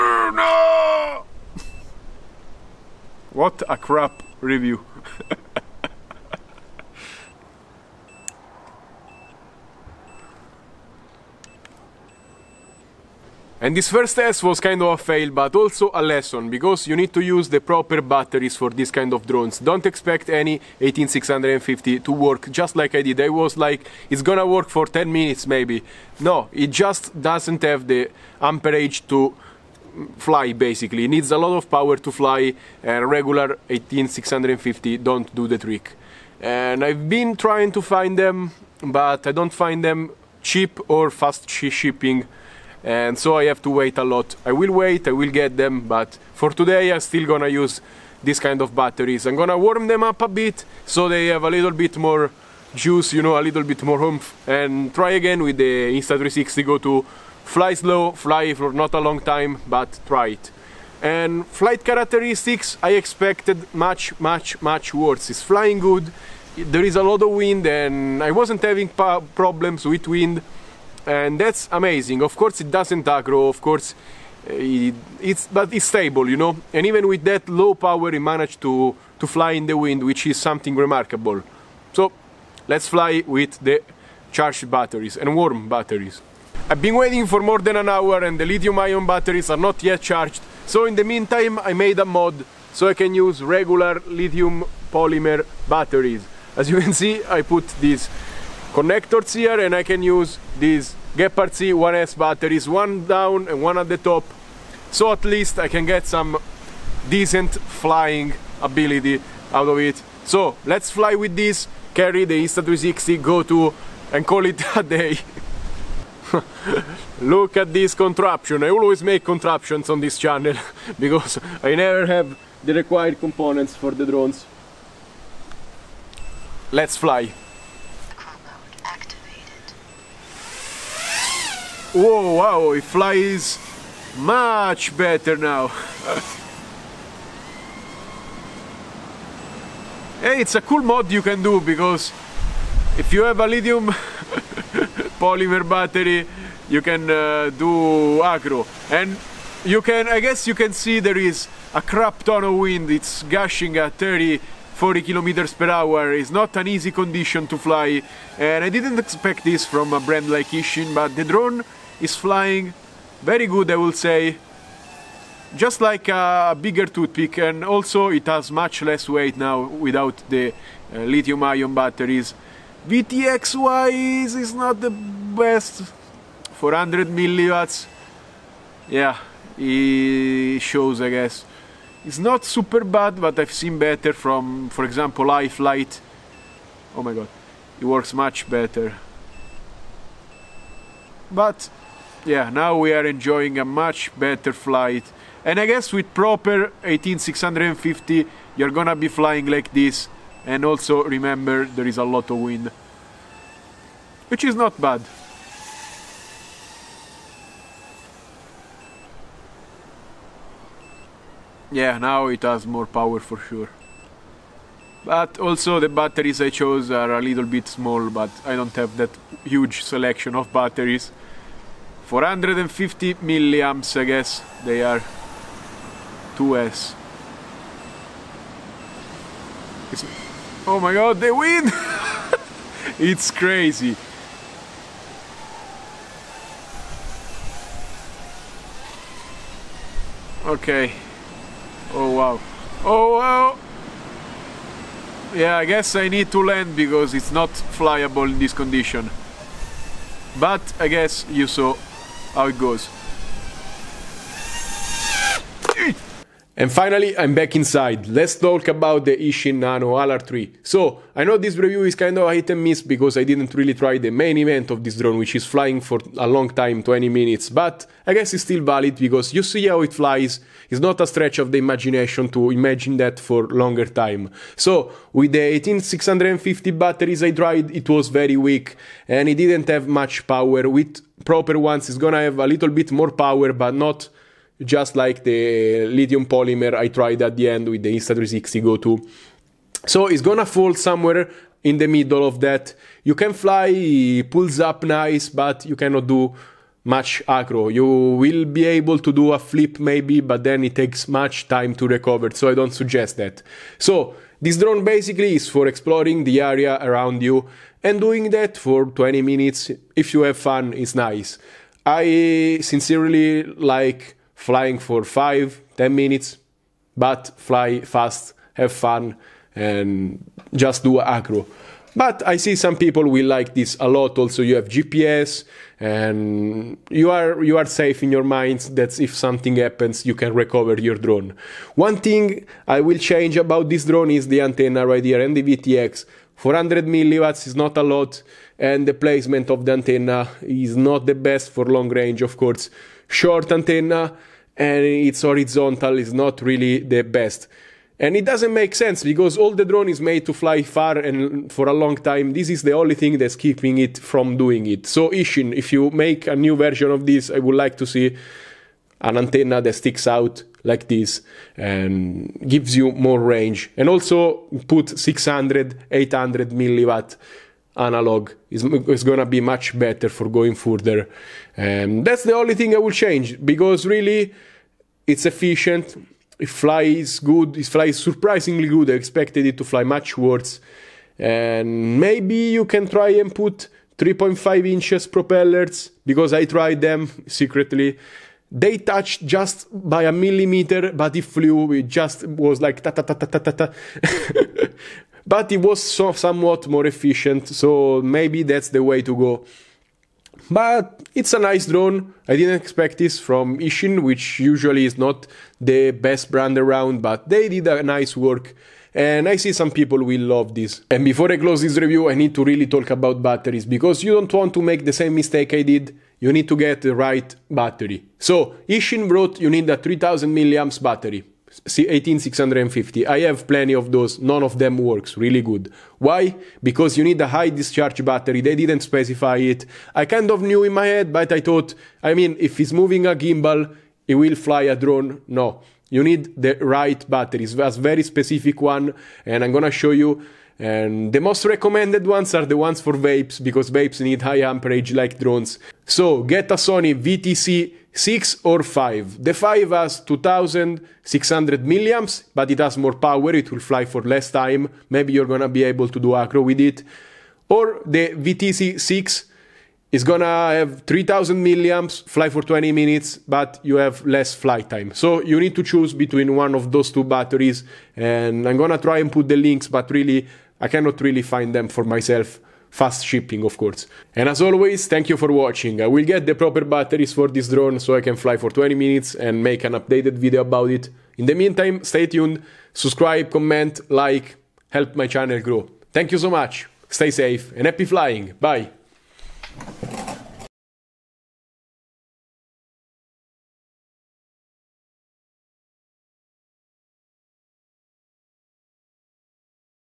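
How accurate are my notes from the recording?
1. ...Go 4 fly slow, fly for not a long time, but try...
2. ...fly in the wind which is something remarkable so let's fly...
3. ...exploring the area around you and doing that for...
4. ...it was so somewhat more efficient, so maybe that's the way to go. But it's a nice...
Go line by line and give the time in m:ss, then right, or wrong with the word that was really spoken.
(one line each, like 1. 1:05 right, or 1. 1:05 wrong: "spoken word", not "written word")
1. 0:56 wrong: "2", not "4"
2. 1:19 right
3. 5:05 right
4. 6:35 right.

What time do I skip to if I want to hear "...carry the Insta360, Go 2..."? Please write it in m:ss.
1:51.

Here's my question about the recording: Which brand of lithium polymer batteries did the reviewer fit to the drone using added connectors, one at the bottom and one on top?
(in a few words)
Gepard.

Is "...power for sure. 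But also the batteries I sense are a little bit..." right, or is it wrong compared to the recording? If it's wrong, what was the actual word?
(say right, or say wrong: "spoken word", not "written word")
wrong: "chose", not "sense".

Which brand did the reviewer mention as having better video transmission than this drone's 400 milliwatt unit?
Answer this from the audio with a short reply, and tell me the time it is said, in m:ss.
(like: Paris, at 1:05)
iFlight, at 3:05.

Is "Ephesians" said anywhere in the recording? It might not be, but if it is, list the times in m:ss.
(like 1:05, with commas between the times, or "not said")
not said.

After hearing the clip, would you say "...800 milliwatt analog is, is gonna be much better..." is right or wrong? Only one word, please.
right.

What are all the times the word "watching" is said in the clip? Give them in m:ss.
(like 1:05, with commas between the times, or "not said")
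7:55.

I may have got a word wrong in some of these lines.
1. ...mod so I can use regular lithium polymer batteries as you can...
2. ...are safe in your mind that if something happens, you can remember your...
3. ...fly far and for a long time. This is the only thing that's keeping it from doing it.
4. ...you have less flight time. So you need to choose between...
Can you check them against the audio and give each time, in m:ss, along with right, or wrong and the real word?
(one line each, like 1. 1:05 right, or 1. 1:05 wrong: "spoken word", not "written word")
1. 1:32 right
2. 5:27 wrong: "recover", not "remember"
3. 5:50 right
4. 7:43 right.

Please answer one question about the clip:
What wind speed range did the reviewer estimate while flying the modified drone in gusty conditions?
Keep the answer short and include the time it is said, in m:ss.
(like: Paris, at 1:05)
30-40 km/h, at 2:33.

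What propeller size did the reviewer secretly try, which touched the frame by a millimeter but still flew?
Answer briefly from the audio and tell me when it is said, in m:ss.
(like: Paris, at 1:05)
3.5 inches, at 6:23.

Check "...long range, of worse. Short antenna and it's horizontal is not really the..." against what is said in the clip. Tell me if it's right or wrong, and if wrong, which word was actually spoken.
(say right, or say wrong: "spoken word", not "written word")
wrong: "course", not "worse".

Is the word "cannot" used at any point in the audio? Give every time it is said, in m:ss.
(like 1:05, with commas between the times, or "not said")
4:55, 7:50.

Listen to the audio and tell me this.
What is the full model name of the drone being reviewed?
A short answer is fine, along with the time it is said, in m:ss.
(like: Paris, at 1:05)
Eachine Nano LR3, at 4:19.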